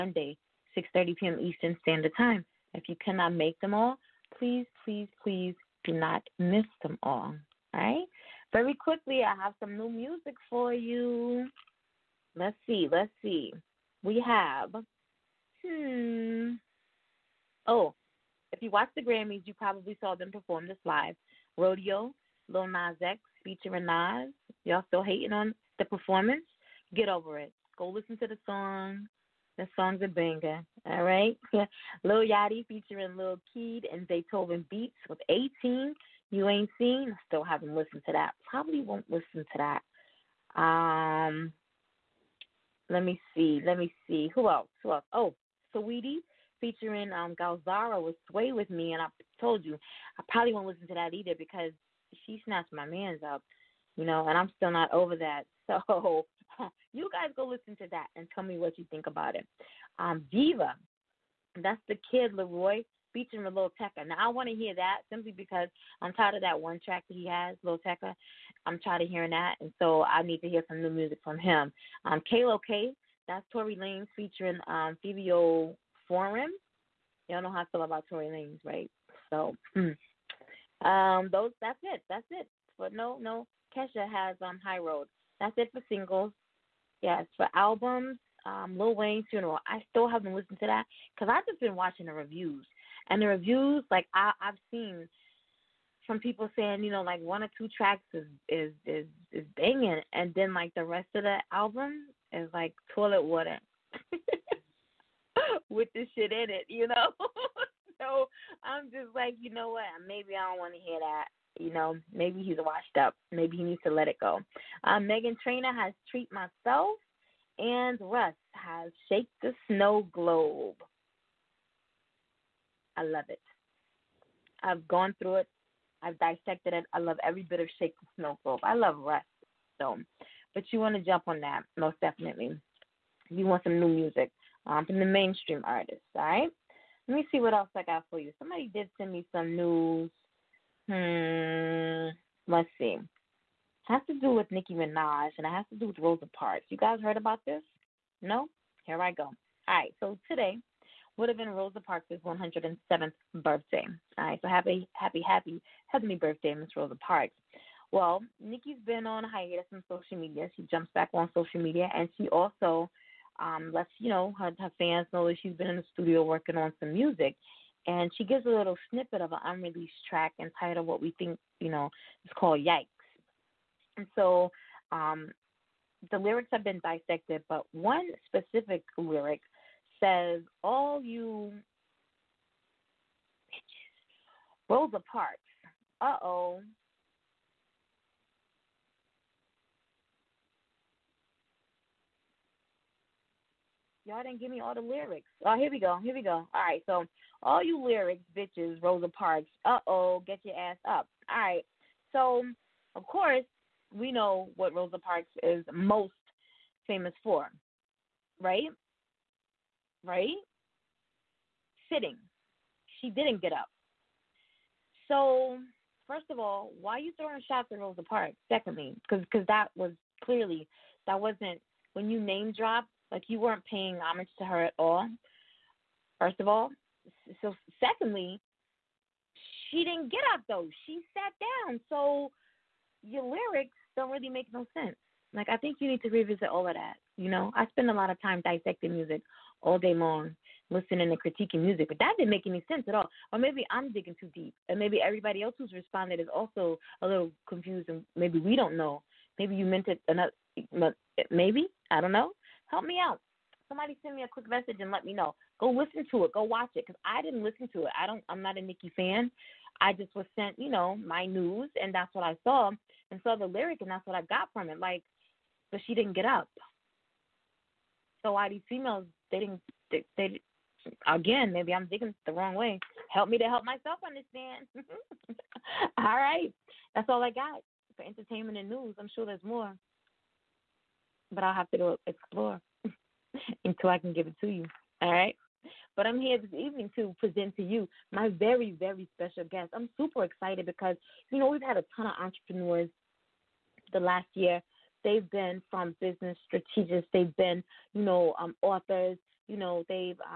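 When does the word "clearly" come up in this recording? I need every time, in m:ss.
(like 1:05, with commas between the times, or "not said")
3:40.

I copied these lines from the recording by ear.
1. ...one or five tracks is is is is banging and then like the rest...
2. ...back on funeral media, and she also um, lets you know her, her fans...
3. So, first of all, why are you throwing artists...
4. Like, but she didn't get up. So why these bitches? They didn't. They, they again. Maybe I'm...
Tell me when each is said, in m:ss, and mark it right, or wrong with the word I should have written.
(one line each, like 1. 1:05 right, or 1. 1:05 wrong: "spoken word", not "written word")
1. 1:37 wrong: "two", not "five"
2. 2:40 wrong: "social", not "funeral"
3. 3:35 wrong: "shots", not "artists"
4. 4:24 wrong: "females", not "bitches".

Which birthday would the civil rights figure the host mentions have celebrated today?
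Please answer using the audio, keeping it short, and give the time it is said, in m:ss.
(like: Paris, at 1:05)
107th, at 2:32.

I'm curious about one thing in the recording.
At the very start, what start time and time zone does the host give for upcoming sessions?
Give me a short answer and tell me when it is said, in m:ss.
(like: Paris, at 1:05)
6:30 p.m. Eastern, at 0:00.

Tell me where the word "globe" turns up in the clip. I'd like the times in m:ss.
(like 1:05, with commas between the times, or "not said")
2:00, 2:08.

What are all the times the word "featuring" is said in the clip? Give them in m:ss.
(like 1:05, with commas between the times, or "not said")
0:23, 0:32, 0:46, 1:03, 1:14.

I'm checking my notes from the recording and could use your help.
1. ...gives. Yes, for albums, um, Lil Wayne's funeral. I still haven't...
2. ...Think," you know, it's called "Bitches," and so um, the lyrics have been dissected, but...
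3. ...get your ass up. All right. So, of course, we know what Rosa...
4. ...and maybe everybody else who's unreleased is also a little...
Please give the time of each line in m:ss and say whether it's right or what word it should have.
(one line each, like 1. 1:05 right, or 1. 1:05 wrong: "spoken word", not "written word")
1. 1:25 wrong: "singles", not "gives"
2. 2:51 wrong: "Yikes", not "Bitches"
3. 3:20 right
4. 4:04 wrong: "responded", not "unreleased".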